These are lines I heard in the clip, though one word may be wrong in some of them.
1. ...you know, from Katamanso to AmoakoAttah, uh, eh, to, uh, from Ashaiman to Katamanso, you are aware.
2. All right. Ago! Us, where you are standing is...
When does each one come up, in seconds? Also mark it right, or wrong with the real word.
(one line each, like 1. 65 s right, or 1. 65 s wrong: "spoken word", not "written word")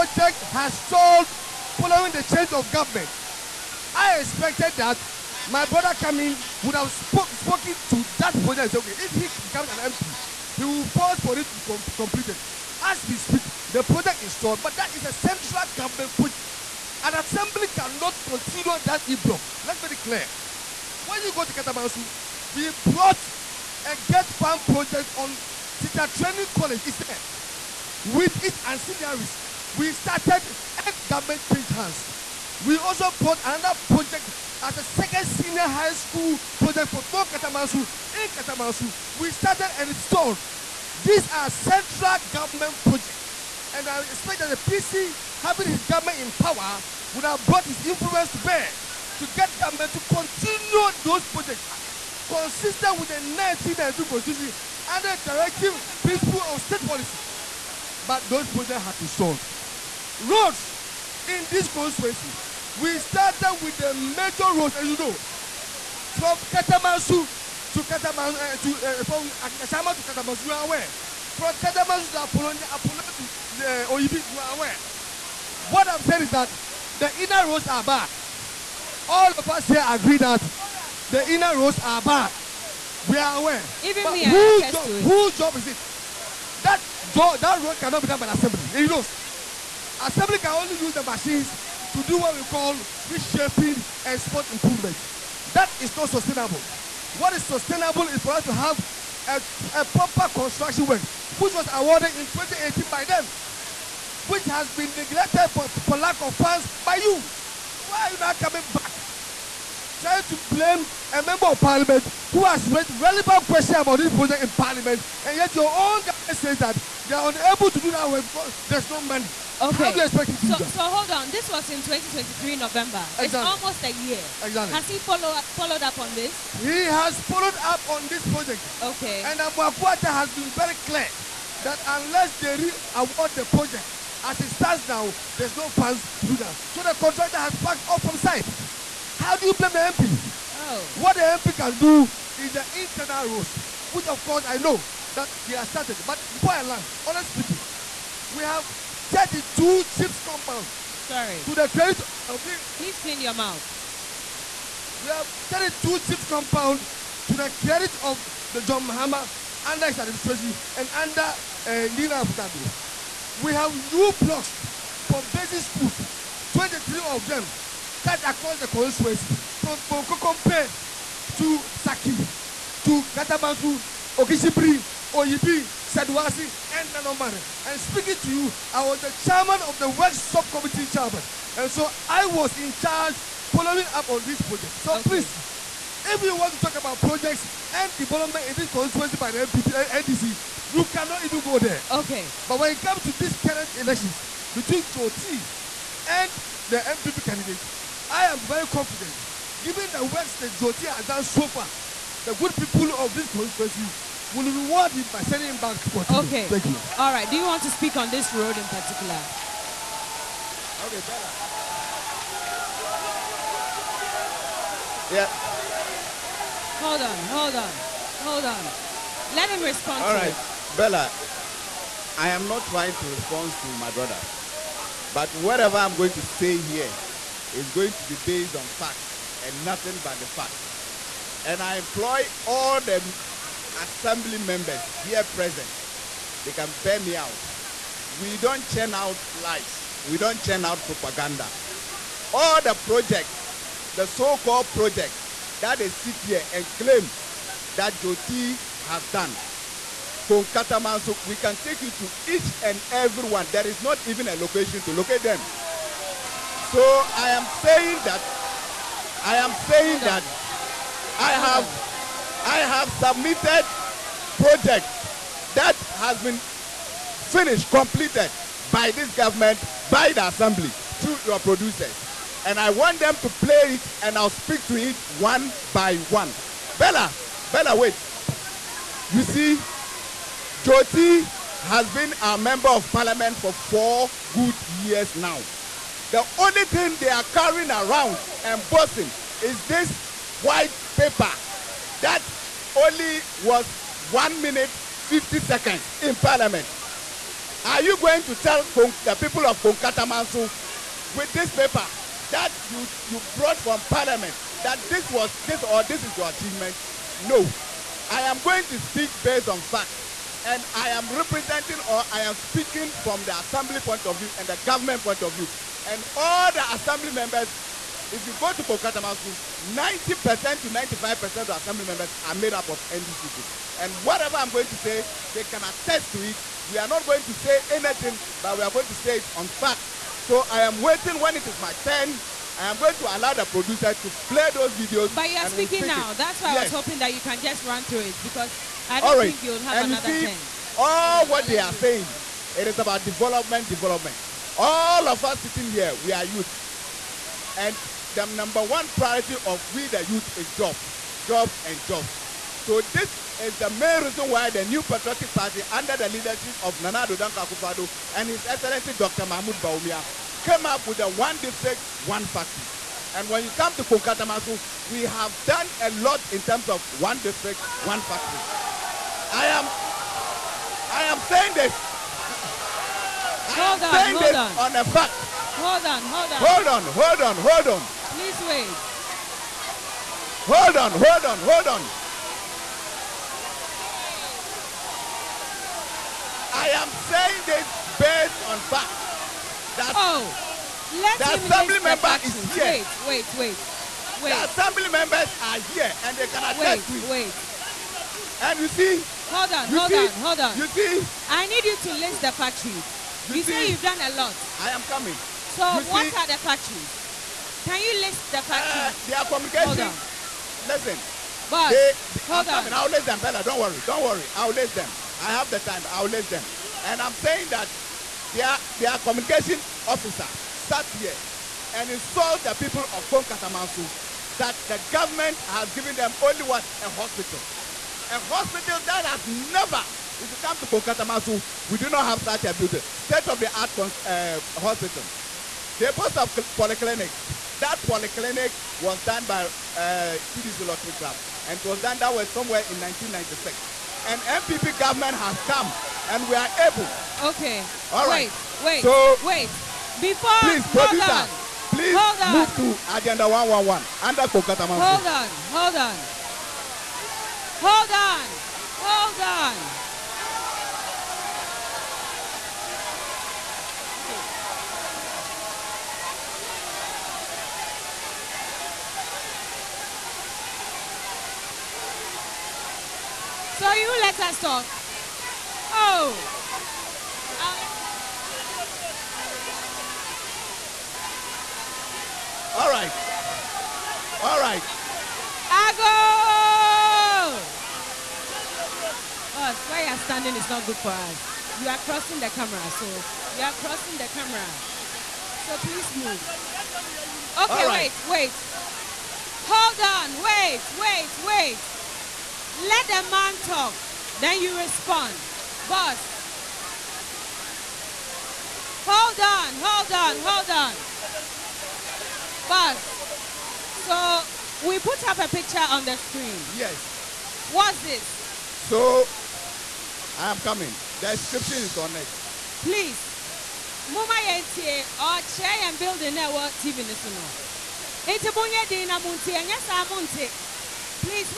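1. 64 s wrong: "Katamanso", not "AmoakoAttah"
2. 484 s right.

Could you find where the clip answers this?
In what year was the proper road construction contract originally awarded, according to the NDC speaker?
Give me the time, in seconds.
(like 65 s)
102 s.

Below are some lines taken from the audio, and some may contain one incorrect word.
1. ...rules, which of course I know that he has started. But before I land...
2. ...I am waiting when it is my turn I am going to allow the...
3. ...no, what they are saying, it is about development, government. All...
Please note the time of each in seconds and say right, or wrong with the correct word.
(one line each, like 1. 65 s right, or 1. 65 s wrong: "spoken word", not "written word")
1. 143 s right
2. 330 s right
3. 341 s wrong: "development", not "government".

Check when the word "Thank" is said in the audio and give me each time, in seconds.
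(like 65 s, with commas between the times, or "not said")
206 s.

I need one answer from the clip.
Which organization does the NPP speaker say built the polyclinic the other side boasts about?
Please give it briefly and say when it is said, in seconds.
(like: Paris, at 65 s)
TDC Rotary Club, at 440 s.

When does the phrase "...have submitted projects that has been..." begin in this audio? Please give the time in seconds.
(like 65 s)
262 s.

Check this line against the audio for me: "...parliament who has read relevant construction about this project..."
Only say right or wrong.
wrong.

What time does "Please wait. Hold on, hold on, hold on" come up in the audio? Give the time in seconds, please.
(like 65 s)
378 s.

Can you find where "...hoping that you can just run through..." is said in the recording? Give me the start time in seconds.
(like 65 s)
336 s.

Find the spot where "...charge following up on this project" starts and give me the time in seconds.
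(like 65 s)
182 s.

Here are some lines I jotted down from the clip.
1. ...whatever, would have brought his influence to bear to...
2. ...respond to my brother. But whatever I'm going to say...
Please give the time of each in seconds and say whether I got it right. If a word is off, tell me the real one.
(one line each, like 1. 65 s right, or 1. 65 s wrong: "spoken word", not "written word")
1. 46 s wrong: "power", not "whatever"
2. 223 s right.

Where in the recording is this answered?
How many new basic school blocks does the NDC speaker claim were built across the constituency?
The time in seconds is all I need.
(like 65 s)
166 s.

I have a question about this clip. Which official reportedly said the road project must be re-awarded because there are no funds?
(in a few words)
Amoako-Attah.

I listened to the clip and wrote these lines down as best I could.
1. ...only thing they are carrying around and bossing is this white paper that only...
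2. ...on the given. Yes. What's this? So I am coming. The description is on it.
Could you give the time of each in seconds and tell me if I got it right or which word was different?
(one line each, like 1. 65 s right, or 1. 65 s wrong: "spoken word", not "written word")
1. 286 s right
2. 515 s wrong: "screen", not "given".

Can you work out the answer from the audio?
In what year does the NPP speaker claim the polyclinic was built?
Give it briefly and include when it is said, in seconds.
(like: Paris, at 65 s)
1996, at 442 s.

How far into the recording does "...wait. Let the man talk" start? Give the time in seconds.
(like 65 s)
501 s.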